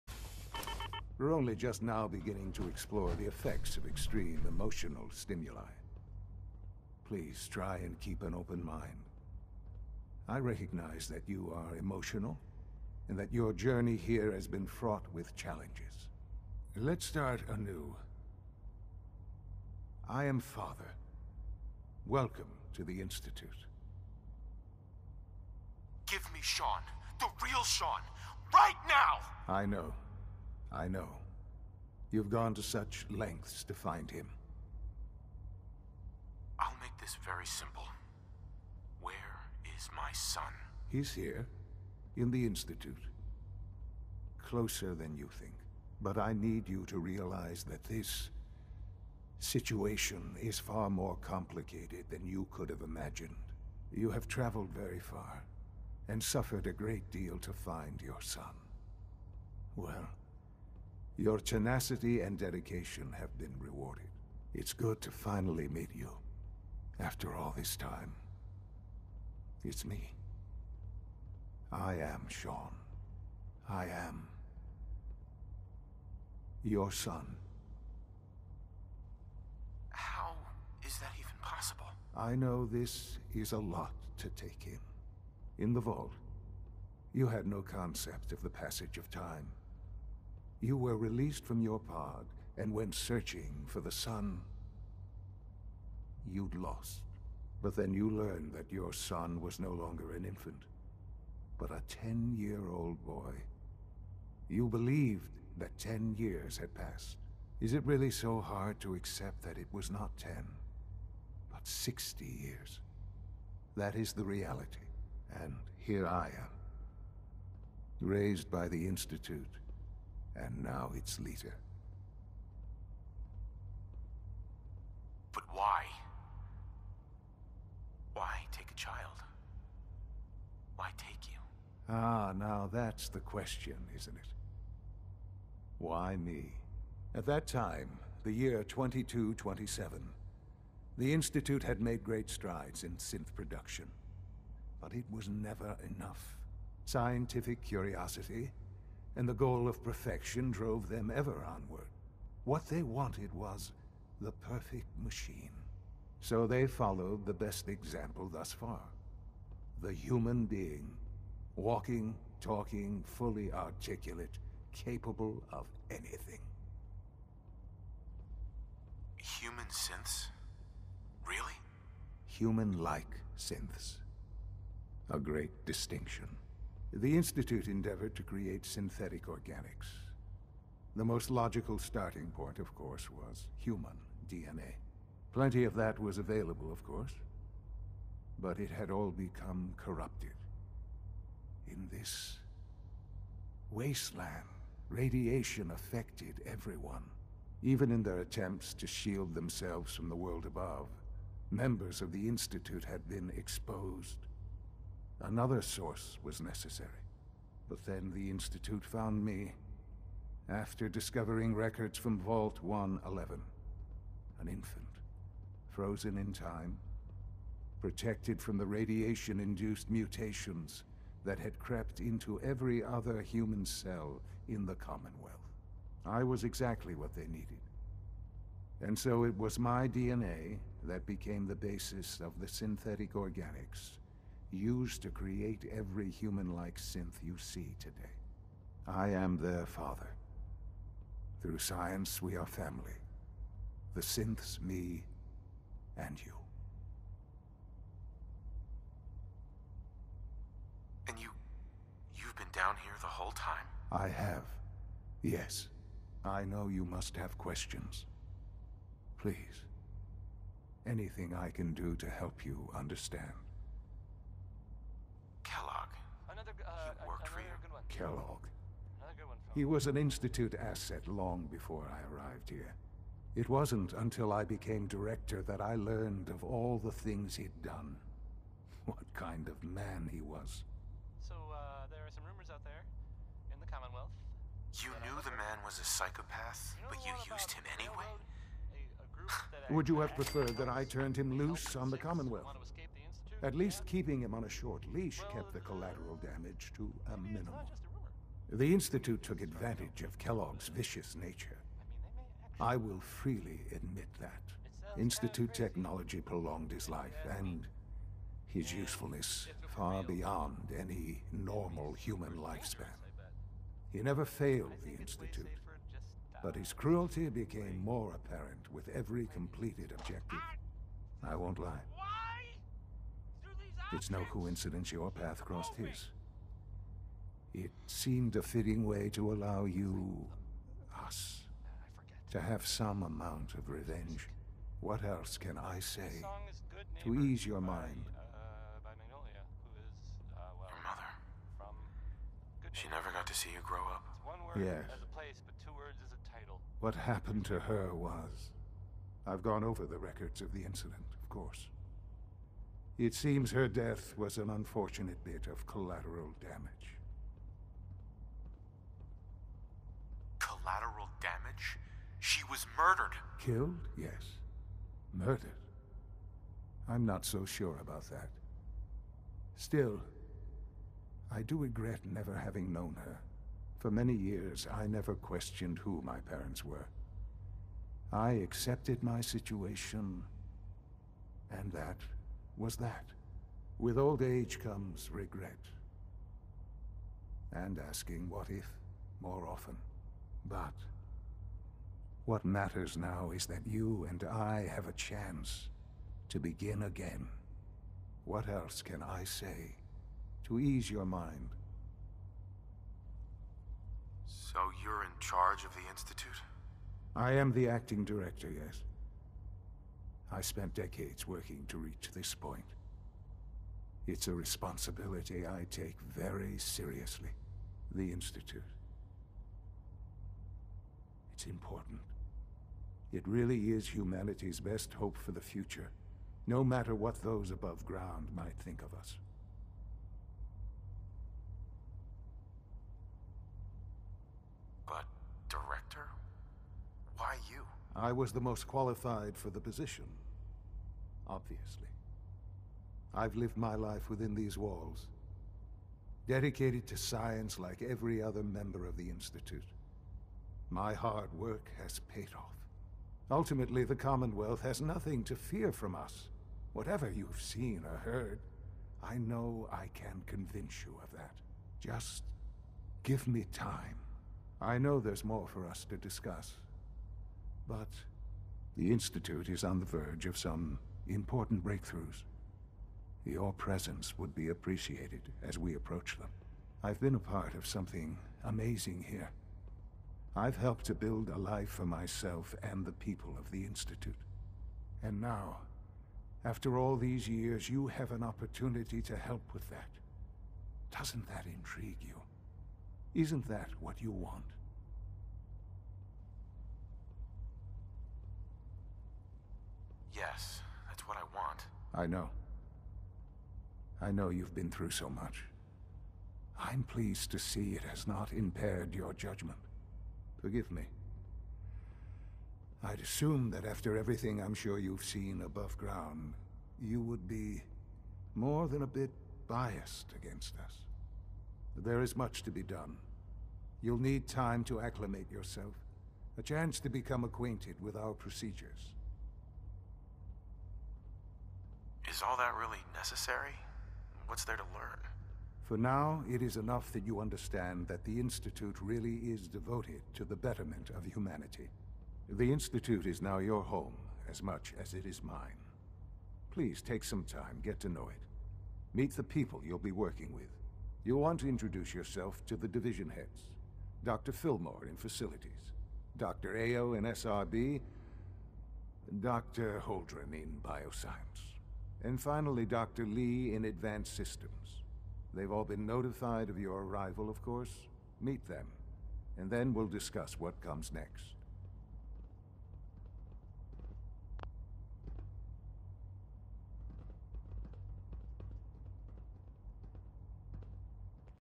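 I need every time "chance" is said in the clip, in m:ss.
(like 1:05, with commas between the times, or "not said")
6:34, 8:46.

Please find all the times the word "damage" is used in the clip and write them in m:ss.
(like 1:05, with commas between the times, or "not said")
4:56, 5:56.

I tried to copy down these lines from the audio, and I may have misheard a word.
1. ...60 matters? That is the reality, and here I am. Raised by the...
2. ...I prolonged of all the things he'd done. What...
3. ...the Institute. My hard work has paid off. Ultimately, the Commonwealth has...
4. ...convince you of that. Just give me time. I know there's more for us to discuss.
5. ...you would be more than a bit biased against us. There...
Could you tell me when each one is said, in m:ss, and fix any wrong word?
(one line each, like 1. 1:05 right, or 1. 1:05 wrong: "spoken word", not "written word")
1. 1:51 wrong: "years", not "matters"
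2. 4:35 wrong: "learned", not "prolonged"
3. 7:28 right
4. 7:40 right
5. 8:36 right.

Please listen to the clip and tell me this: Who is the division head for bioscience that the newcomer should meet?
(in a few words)
Dr. Holdren.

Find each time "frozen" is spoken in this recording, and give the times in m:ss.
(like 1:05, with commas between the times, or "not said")
3:35.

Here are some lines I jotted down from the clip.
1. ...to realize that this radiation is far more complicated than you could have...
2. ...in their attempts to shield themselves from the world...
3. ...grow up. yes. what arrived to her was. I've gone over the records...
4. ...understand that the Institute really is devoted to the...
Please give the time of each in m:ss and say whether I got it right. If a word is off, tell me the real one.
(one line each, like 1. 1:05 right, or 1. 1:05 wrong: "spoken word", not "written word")
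1. 0:46 wrong: "situation", not "radiation"
2. 3:17 right
3. 5:43 wrong: "happened", not "arrived"
4. 8:57 right.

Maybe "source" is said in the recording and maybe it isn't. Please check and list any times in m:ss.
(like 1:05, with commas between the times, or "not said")
3:25.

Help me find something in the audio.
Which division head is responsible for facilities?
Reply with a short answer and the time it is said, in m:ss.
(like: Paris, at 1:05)
Dr. Filmore, at 9:14.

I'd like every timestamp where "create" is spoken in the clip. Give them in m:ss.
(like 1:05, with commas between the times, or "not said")
2:58, 3:55.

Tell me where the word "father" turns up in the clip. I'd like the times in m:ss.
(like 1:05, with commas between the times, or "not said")
0:20, 3:59.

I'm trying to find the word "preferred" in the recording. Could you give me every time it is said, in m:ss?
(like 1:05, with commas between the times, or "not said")
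4:50.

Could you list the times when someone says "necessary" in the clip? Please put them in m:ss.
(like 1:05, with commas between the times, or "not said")
3:26, 8:52.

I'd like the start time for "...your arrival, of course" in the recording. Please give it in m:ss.
9:26.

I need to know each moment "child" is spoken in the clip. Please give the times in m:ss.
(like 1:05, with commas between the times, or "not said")
2:08.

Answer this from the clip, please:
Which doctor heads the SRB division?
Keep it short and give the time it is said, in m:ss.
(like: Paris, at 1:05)
Dr. Ayo, at 9:16.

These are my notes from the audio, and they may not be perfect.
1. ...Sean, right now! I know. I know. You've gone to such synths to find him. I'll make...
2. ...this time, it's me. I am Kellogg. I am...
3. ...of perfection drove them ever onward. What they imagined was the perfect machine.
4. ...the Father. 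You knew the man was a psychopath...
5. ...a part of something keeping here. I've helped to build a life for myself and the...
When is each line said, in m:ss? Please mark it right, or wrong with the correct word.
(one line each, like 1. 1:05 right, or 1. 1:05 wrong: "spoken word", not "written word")
1. 0:27 wrong: "lengths", not "synths"
2. 1:07 wrong: "Sean", not "Kellogg"
3. 2:29 wrong: "wanted", not "imagined"
4. 4:43 wrong: "Commonwealth", not "Father"
5. 7:57 wrong: "amazing", not "keeping".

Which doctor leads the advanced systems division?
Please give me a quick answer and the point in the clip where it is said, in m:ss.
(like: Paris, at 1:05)
Dr. Li, at 9:22.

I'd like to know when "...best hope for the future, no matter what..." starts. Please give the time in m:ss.
7:04.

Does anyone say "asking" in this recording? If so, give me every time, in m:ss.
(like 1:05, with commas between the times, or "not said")
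6:27.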